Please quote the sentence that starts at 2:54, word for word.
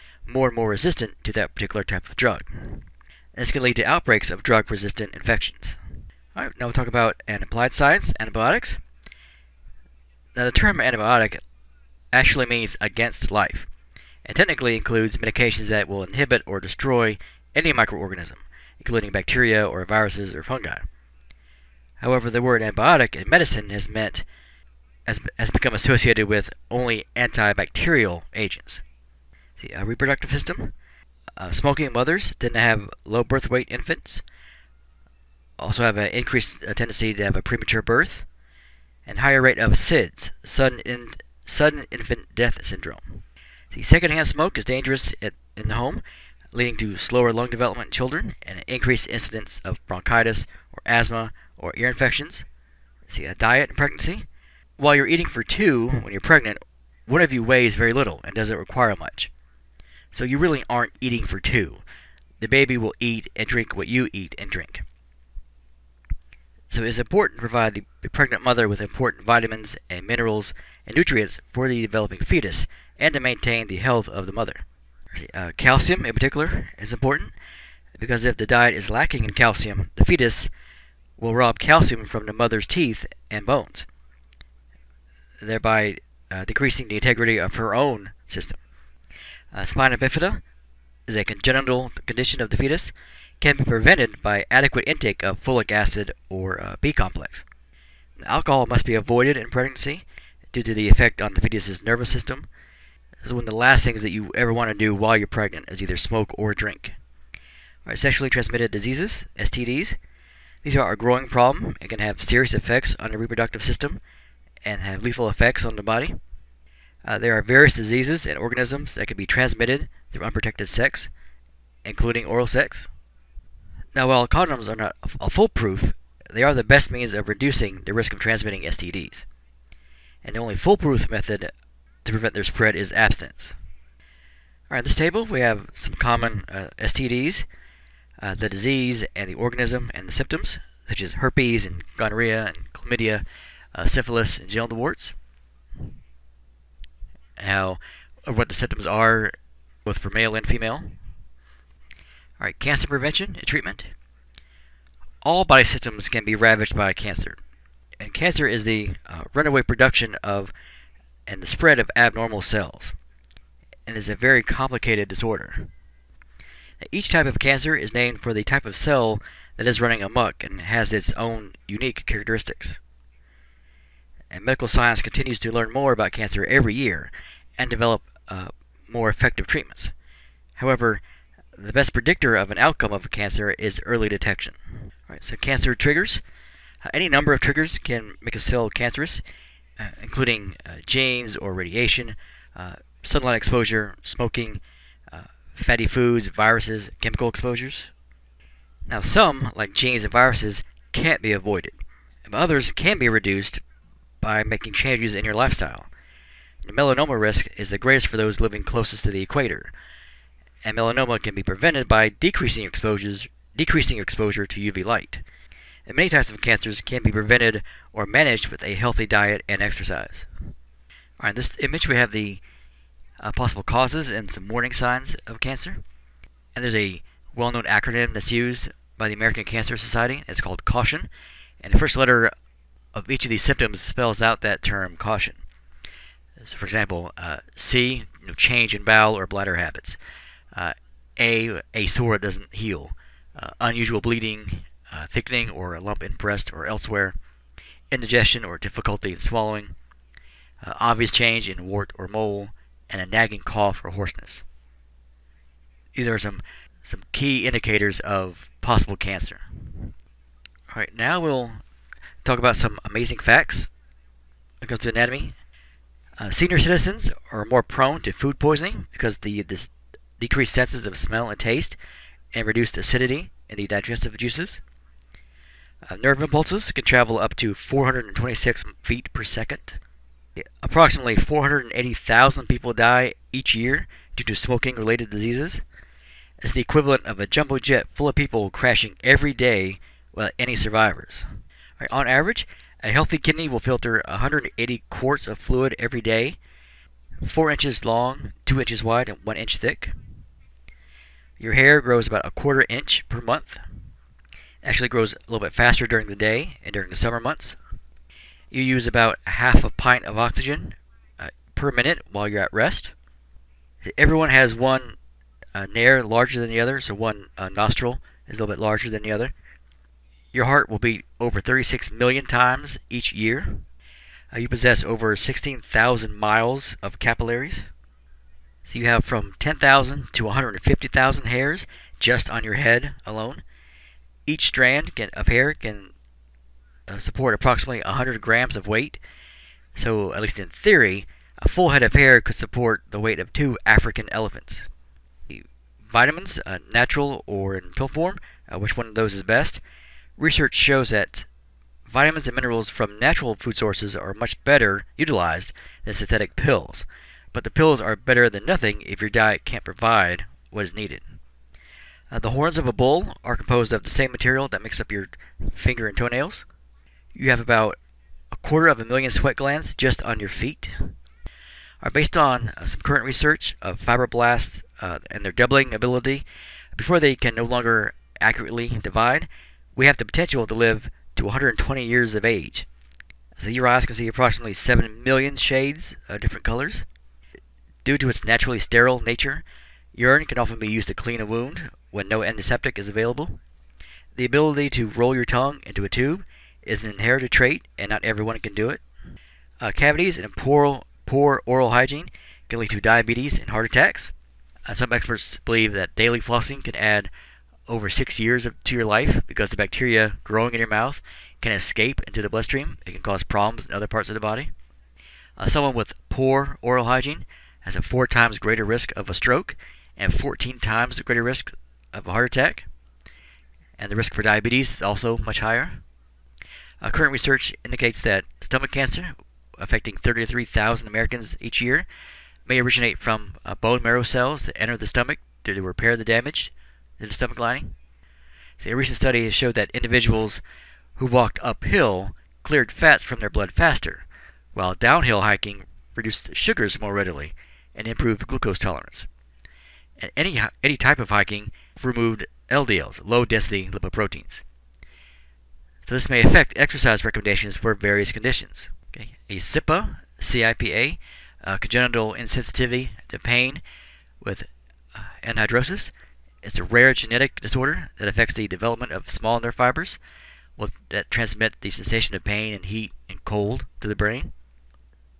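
And medical science continues to learn more about cancer every year, and develop uh, more effective treatments.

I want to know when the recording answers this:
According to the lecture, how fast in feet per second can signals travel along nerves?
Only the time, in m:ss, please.
4:37.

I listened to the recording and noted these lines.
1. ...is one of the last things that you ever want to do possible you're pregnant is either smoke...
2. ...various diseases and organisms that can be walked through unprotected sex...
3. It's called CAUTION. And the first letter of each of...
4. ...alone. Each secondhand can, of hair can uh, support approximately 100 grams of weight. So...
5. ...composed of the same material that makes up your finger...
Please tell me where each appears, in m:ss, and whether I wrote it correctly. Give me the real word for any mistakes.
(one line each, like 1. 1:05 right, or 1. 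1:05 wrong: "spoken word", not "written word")
1. 1:43 wrong: "while", not "possible"
2. 1:57 wrong: "transmitted", not "walked"
3. 3:50 right
4. 5:33 wrong: "strand", not "secondhand"
5. 6:03 right.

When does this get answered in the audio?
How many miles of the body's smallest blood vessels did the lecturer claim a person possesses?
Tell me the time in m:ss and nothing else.
5:25.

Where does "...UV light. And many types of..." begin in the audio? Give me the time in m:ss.
3:34.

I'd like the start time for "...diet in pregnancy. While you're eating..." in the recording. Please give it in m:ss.
0:53.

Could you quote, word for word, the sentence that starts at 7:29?
And any, any type of hiking removed LDLs, low density lipoproteins.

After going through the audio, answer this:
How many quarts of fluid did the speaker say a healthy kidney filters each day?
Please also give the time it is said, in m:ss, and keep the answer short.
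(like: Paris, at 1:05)
180 quarts, at 4:54.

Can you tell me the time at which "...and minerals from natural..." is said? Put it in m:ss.
5:52.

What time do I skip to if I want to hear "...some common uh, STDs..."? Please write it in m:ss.
2:15.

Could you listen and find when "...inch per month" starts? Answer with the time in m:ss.
5:02.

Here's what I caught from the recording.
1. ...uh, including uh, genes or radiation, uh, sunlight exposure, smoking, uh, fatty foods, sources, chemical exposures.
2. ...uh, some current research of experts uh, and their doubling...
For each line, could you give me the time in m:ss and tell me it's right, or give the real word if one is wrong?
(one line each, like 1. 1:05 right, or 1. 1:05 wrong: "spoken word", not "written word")
1. 3:09 wrong: "viruses", not "sources"
2. 6:12 wrong: "fibroblasts", not "experts".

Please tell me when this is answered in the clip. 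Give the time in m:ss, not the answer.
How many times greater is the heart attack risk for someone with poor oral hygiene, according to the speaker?
7:00.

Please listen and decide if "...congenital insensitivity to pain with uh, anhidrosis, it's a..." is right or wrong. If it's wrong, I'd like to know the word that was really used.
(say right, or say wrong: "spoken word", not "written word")
right.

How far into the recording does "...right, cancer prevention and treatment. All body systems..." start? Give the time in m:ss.
2:32.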